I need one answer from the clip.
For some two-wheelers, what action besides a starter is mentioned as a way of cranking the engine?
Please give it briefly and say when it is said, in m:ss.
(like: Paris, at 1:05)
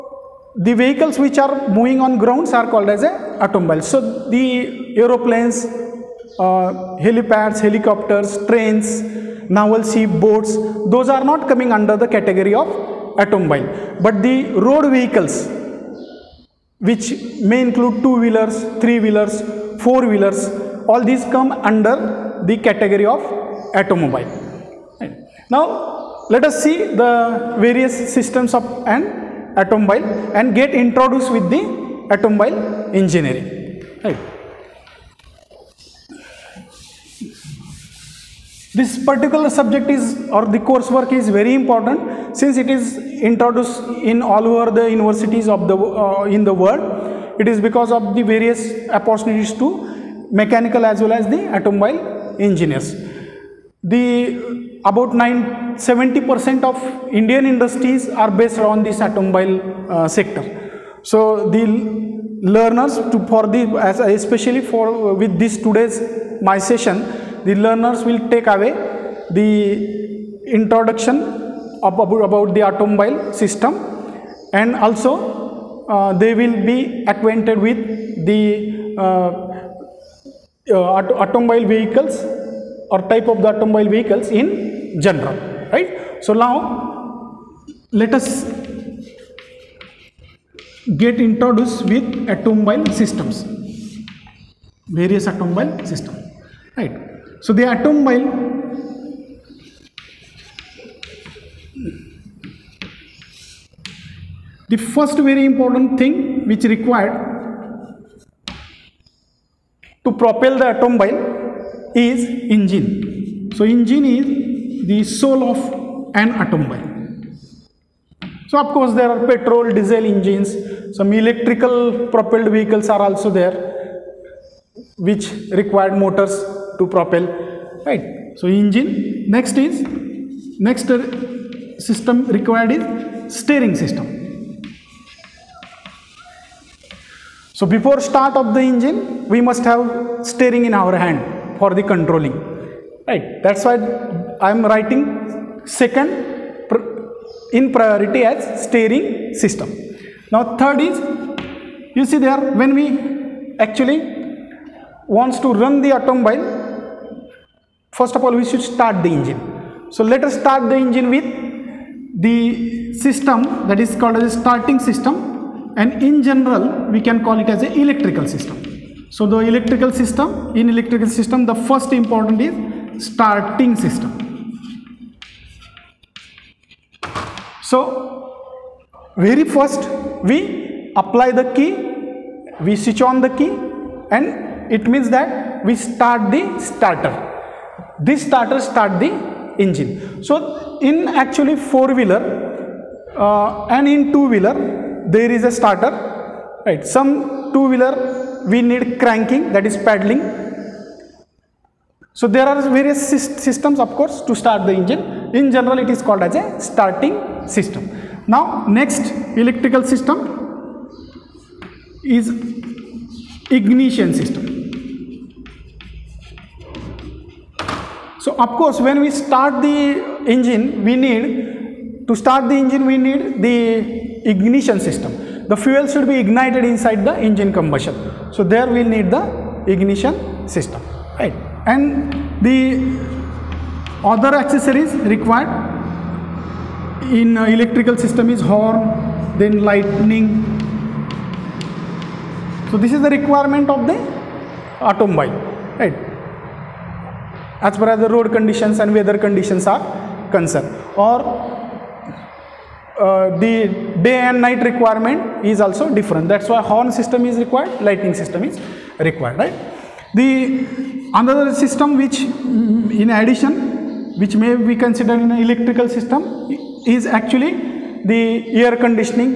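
Paddling, at 3:19.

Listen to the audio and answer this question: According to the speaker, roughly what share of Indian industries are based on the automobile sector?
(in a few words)
70%.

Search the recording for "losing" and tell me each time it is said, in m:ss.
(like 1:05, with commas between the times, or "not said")
not said.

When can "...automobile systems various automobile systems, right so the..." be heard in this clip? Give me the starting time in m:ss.
1:32.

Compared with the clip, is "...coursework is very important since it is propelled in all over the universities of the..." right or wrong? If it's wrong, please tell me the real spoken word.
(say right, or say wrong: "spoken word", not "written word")
wrong: "introduced", not "propelled".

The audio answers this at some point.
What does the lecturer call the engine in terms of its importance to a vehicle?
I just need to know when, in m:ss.
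1:55.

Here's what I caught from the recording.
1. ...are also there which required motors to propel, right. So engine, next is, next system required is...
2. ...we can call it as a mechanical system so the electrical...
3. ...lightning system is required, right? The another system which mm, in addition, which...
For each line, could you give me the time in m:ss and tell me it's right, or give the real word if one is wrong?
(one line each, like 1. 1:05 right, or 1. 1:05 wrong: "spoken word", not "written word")
1. 2:02 right
2. 2:46 wrong: "electrical", not "mechanical"
3. 4:17 right.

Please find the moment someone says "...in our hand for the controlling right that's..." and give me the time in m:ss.
2:20.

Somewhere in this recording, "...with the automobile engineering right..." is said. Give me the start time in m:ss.
0:31.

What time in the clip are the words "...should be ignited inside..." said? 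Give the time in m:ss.
3:45.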